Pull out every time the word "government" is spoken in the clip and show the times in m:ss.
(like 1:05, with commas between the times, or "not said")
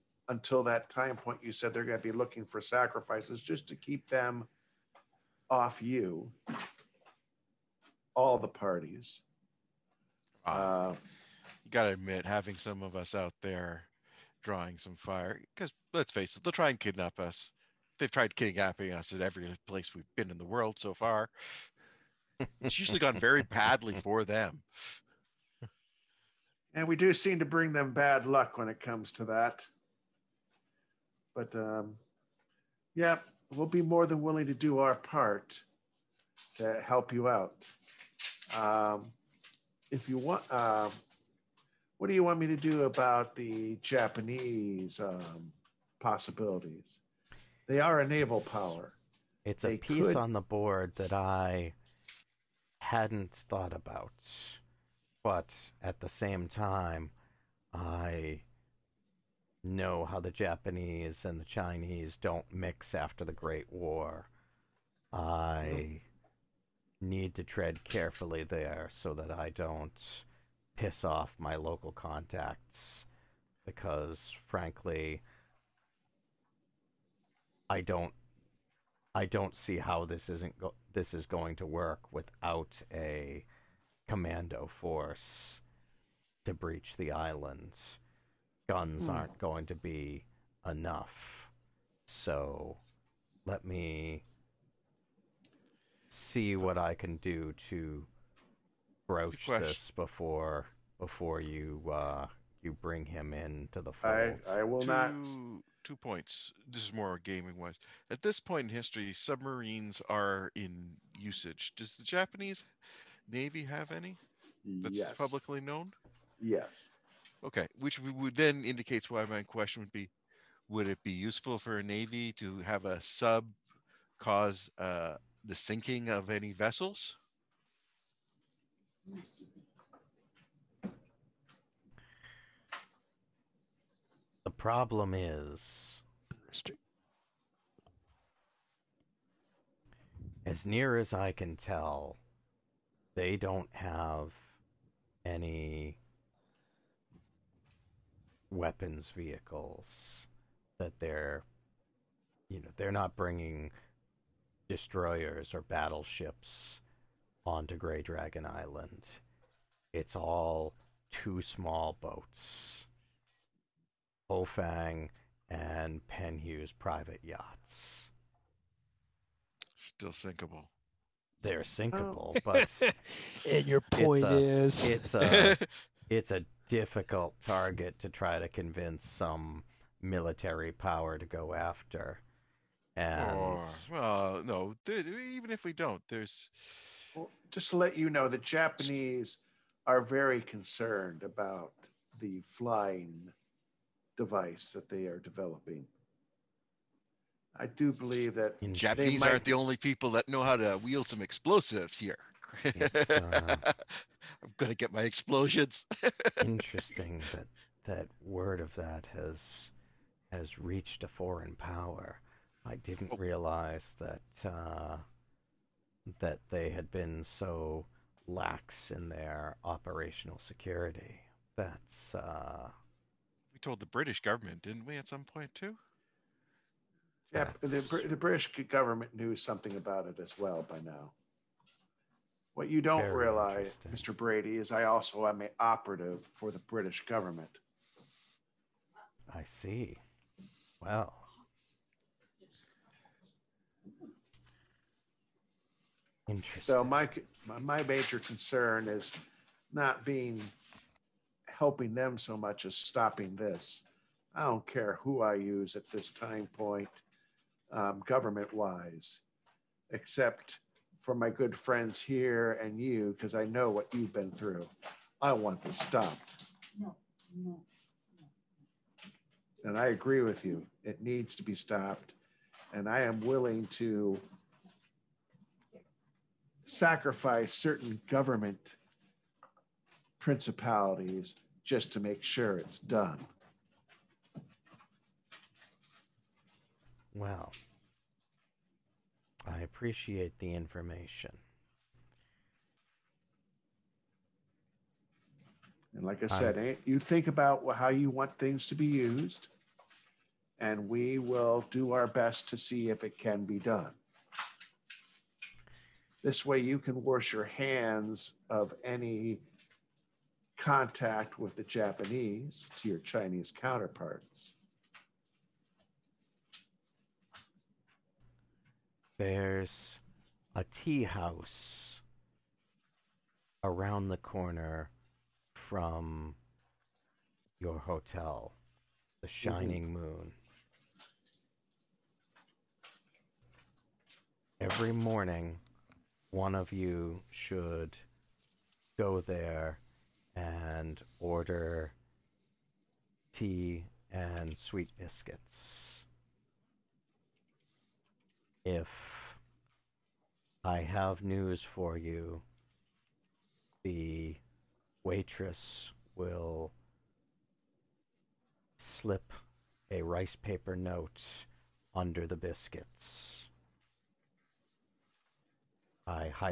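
3:44, 3:48, 3:57, 4:18, 4:38.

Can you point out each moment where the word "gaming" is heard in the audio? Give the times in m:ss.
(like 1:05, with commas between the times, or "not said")
1:47.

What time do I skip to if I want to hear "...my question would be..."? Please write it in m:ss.
1:59.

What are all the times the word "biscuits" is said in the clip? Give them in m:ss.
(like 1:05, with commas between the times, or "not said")
5:44, 6:02.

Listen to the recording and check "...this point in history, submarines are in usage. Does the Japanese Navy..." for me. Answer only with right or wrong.
right.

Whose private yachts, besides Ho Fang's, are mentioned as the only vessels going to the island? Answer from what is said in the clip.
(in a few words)
Penhew.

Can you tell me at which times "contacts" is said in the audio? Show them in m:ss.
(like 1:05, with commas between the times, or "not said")
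1:11, 5:10.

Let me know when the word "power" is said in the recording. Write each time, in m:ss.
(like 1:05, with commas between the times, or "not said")
0:48, 3:00, 3:31.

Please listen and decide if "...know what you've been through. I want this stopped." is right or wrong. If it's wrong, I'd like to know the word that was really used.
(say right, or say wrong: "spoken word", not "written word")
right.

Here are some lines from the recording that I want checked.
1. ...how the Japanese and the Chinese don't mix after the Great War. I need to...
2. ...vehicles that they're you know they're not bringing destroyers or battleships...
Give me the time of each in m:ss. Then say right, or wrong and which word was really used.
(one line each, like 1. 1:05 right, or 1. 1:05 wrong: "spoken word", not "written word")
1. 1:00 right
2. 2:29 right.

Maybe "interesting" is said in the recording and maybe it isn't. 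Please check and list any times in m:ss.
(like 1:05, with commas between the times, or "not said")
3:26, 4:06.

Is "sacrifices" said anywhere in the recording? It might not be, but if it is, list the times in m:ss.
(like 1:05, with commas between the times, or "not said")
0:02, 4:36.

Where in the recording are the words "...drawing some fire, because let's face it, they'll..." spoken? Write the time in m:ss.
0:14.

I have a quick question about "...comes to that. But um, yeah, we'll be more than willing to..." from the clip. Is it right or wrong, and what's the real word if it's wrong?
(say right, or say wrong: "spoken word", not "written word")
right.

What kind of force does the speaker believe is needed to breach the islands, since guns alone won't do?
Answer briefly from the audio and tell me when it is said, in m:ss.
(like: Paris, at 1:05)
A commando force, at 1:24.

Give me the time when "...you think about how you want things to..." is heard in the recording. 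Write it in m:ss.
4:56.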